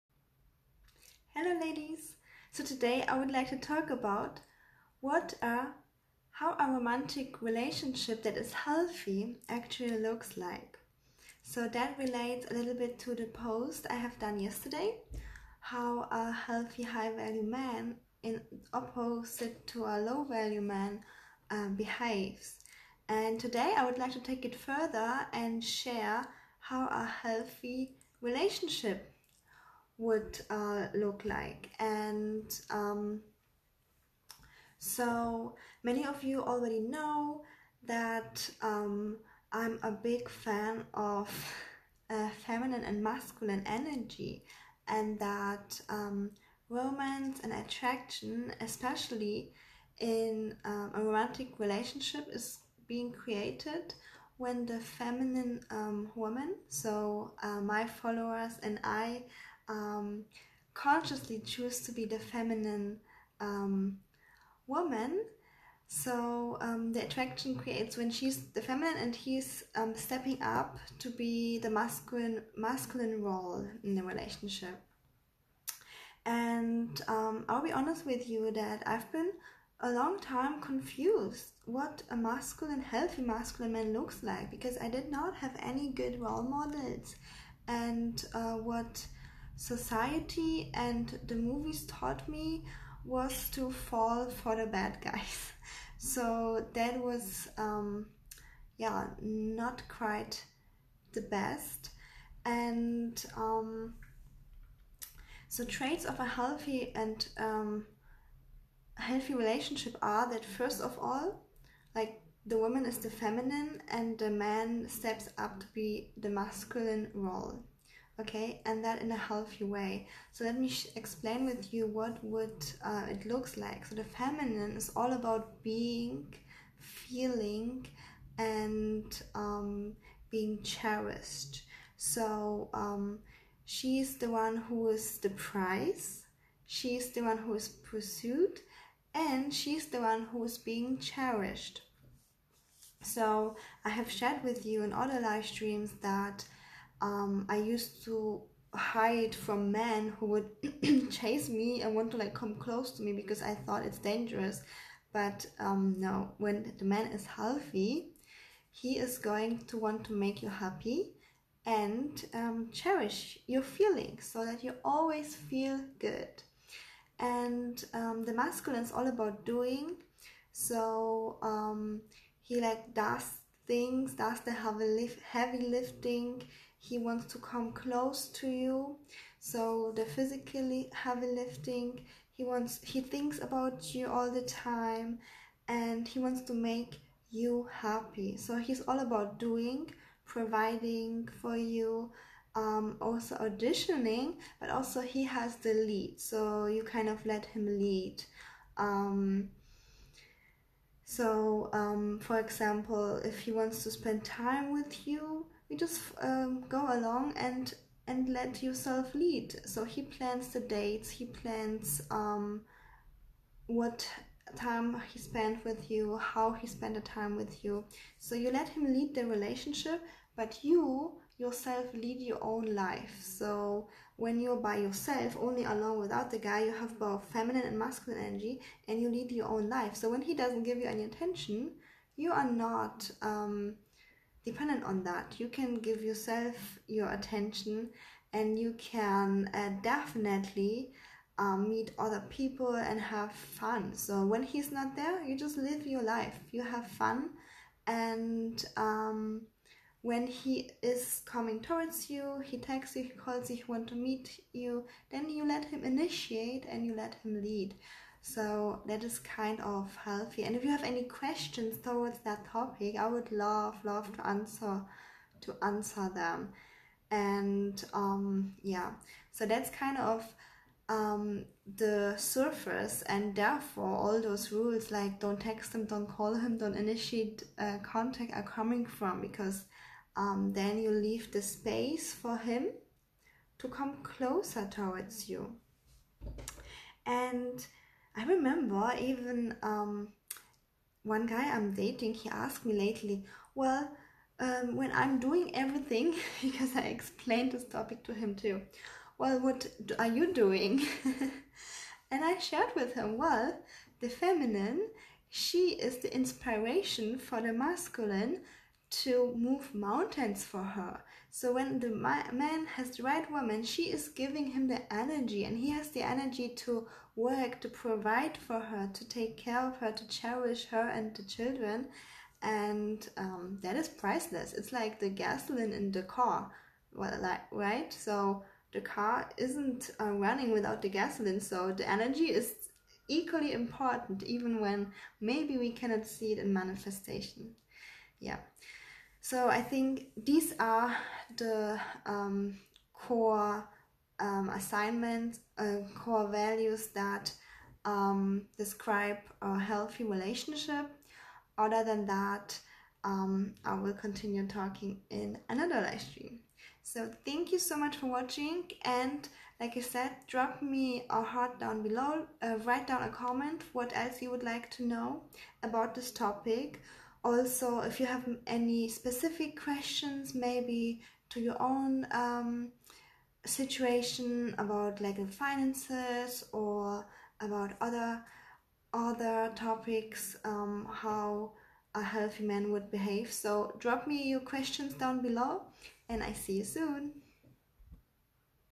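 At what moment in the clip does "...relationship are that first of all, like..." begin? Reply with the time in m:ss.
1:49.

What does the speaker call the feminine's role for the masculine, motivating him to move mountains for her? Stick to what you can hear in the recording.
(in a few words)
the inspiration.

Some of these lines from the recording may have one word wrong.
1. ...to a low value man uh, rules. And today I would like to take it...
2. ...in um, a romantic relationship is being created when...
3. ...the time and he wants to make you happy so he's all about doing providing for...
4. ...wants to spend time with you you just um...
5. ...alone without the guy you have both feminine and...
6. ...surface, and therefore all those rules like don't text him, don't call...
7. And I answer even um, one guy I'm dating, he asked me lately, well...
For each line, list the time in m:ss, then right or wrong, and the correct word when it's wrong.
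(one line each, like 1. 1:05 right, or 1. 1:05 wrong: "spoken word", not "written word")
1. 0:19 wrong: "behaves", not "rules"
2. 0:49 right
3. 3:04 right
4. 3:23 right
5. 3:45 right
6. 4:32 right
7. 4:47 wrong: "remember", not "answer".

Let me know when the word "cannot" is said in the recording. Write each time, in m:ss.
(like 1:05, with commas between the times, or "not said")
5:35.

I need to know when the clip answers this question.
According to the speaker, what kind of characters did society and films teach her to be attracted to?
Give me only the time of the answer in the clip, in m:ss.
1:34.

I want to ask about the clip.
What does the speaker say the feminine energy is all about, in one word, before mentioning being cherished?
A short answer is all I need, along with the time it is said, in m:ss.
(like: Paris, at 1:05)
feeling, at 2:06.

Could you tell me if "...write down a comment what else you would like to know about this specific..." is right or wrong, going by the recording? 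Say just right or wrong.
wrong.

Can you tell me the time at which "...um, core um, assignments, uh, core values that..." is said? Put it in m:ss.
5:42.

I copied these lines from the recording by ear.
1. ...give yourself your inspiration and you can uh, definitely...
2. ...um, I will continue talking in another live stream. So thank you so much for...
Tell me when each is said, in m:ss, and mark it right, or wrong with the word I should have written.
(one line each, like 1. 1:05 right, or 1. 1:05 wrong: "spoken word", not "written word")
1. 3:55 wrong: "attention", not "inspiration"
2. 5:53 right.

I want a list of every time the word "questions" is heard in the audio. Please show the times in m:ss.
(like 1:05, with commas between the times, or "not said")
4:21, 6:09, 6:24.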